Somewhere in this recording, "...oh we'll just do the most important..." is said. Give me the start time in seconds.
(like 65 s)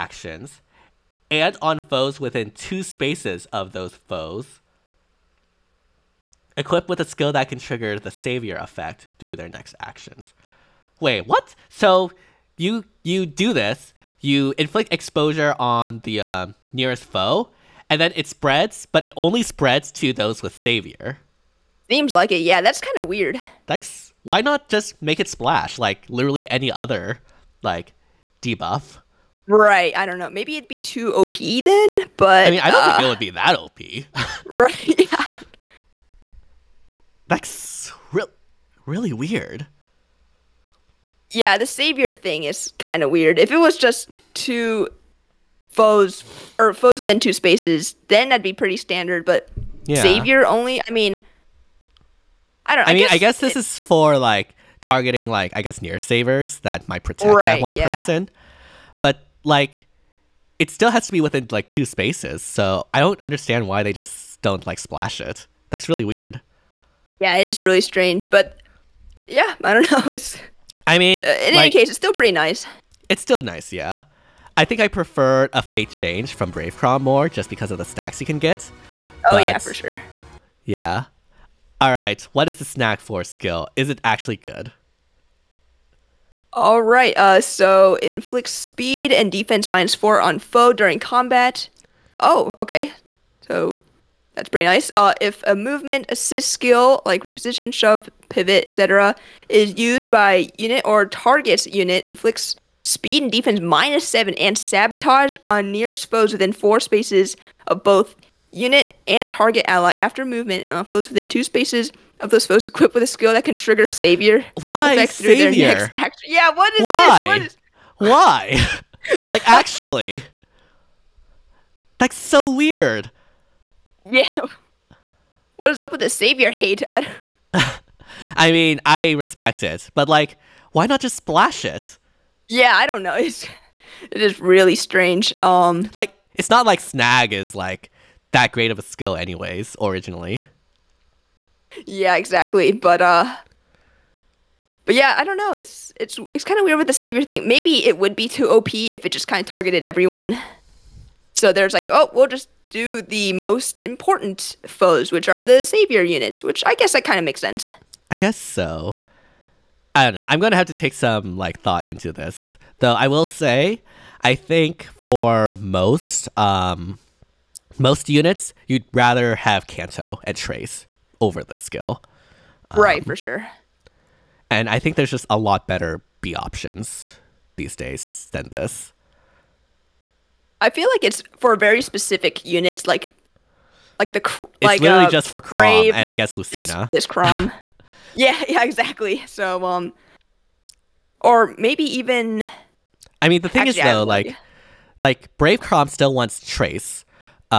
151 s.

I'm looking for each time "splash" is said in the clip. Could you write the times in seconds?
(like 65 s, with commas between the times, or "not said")
25 s, 64 s, 131 s.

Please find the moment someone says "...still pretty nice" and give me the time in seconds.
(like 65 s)
71 s.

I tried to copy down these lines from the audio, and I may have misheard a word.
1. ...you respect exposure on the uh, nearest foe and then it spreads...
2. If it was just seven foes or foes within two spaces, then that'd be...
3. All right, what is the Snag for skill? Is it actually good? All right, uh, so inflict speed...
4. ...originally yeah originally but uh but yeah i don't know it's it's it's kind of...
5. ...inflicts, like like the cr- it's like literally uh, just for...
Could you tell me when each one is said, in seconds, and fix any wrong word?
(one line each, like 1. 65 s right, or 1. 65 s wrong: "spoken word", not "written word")
1. 14 s wrong: "inflict", not "respect"
2. 43 s wrong: "two", not "seven"
3. 81 s right
4. 139 s wrong: "exactly", not "originally"
5. 182 s wrong: "units", not "inflicts".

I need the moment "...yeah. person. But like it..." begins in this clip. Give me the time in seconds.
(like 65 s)
57 s.